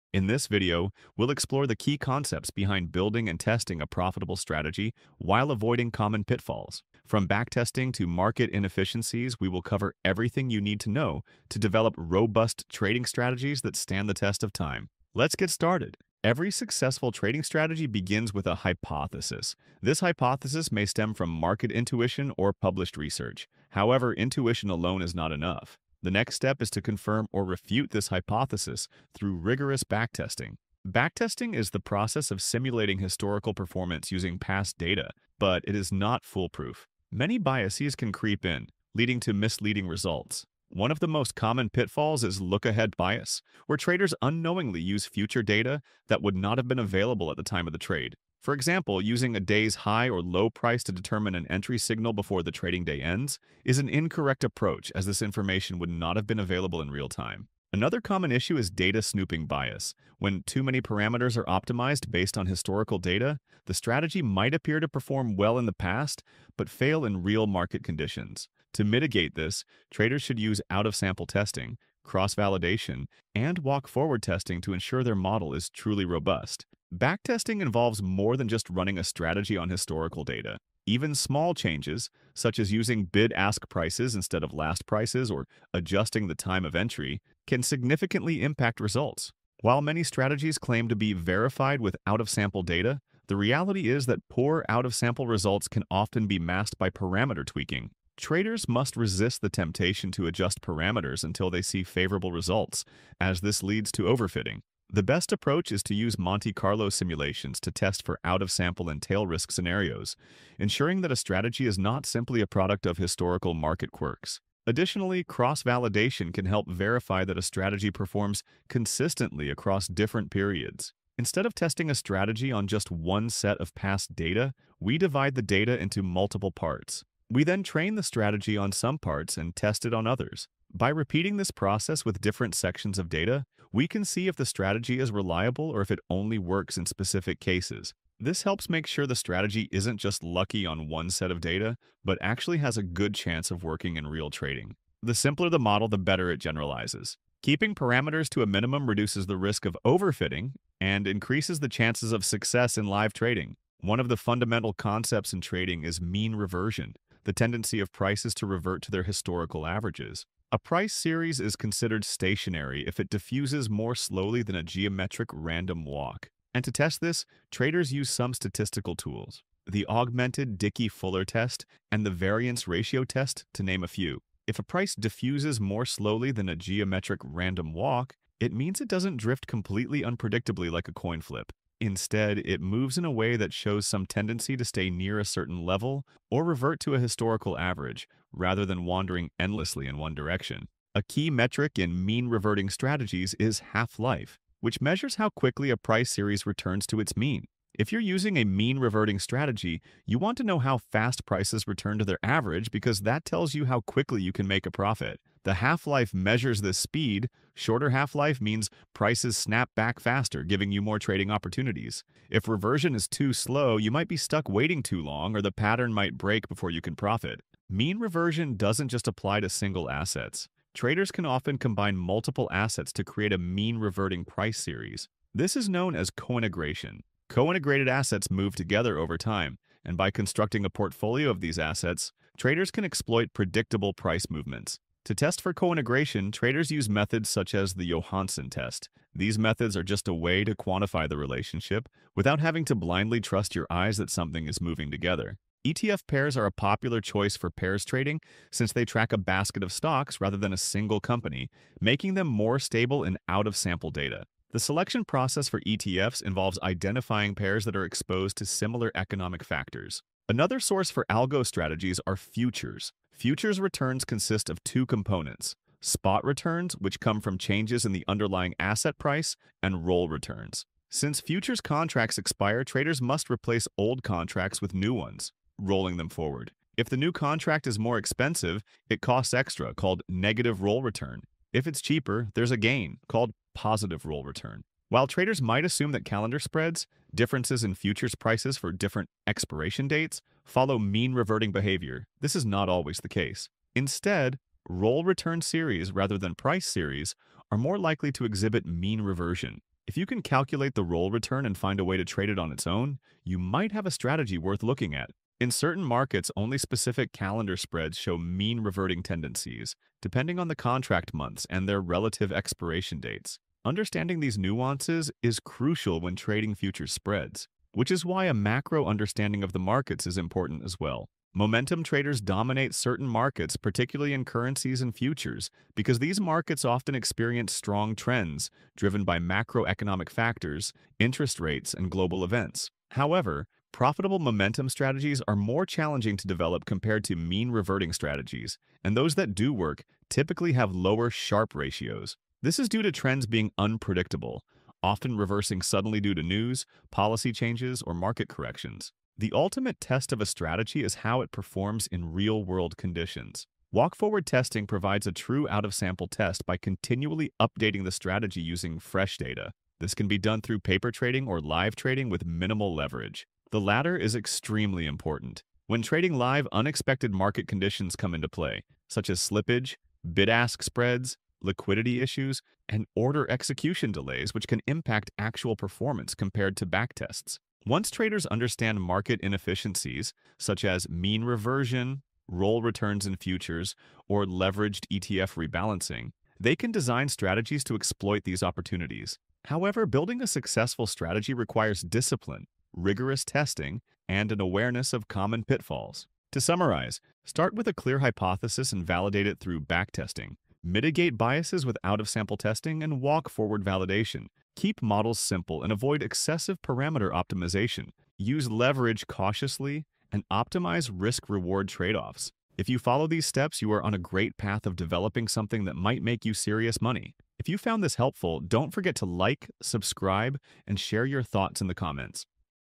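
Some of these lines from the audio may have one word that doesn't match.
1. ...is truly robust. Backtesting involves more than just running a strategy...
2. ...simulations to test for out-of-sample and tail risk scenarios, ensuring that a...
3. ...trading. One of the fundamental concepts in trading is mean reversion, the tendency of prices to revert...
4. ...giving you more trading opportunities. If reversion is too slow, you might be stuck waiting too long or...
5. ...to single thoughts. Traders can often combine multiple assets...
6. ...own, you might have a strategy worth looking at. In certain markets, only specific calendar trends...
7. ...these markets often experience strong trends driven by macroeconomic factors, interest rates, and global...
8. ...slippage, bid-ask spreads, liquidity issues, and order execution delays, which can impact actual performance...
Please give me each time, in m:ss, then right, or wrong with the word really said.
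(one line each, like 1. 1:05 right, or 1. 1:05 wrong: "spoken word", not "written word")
1. 1:15 right
2. 1:46 right
3. 2:33 right
4. 3:30 right
5. 3:39 wrong: "assets", not "thoughts"
6. 5:02 wrong: "spreads", not "trends"
7. 5:25 right
8. 6:09 right.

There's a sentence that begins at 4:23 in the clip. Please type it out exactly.
Futures returns consist of two components, spot returns, which come from changes in the underlying asset price, and roll returns.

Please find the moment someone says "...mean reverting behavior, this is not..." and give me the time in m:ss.
4:50.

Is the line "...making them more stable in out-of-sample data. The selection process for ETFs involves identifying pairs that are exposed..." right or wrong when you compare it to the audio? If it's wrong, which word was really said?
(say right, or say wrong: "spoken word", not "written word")
right.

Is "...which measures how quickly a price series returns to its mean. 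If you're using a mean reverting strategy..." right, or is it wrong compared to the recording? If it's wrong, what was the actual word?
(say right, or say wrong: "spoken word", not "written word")
right.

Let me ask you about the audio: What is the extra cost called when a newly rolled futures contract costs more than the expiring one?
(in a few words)
Negative roll return.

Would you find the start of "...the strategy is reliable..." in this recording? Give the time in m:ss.
2:14.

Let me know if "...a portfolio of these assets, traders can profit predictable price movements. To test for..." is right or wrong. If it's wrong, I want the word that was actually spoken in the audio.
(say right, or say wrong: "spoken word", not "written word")
wrong: "exploit", not "profit".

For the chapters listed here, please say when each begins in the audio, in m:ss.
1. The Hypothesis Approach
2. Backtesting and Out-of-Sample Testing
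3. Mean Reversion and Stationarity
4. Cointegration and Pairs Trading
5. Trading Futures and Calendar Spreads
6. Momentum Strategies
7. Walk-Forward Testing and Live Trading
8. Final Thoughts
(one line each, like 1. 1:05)
1. 0:16
2. 1:17
3. 2:34
4. 3:38
5. 4:20
6. 5:21
7. 5:53
8. 6:18.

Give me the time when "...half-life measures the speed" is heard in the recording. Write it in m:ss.
3:25.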